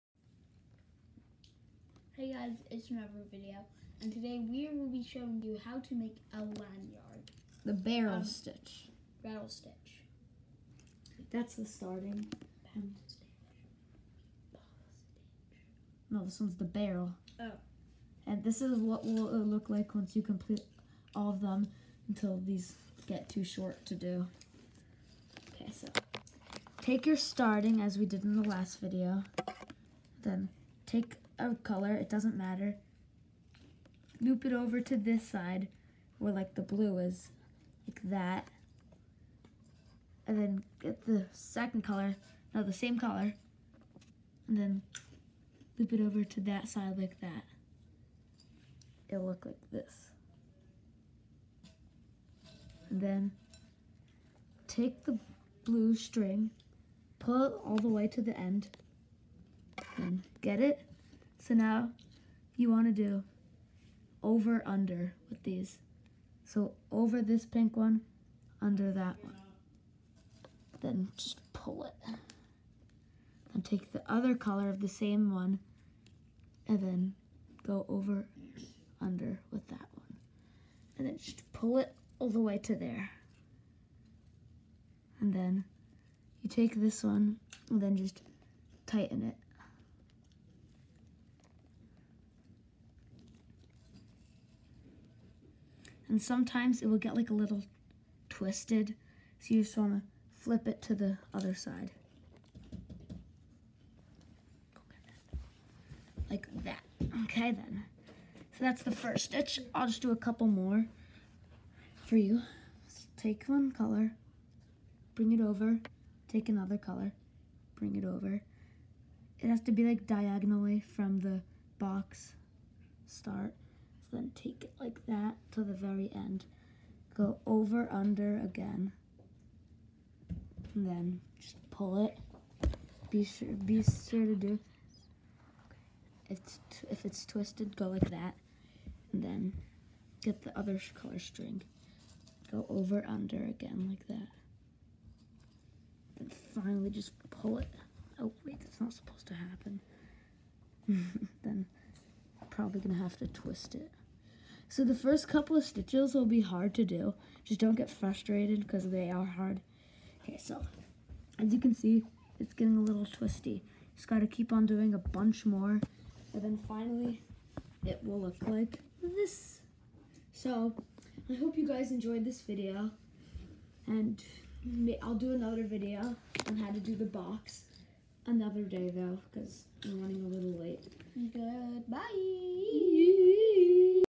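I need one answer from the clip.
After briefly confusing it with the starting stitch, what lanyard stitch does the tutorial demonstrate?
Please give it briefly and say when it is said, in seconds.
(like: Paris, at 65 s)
Barrel stitch, at 9 s.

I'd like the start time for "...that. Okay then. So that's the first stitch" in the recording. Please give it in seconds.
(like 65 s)
106 s.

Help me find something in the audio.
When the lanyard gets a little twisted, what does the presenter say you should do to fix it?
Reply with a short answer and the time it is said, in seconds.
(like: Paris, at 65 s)
Flip it, at 100 s.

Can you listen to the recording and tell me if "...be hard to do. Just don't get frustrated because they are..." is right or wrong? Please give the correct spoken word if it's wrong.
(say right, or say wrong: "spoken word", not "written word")
right.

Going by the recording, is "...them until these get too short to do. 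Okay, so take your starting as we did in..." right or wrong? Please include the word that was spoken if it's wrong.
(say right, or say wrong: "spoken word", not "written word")
right.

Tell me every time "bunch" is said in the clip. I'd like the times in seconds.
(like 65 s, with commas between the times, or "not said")
164 s.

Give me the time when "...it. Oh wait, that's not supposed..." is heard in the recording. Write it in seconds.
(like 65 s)
147 s.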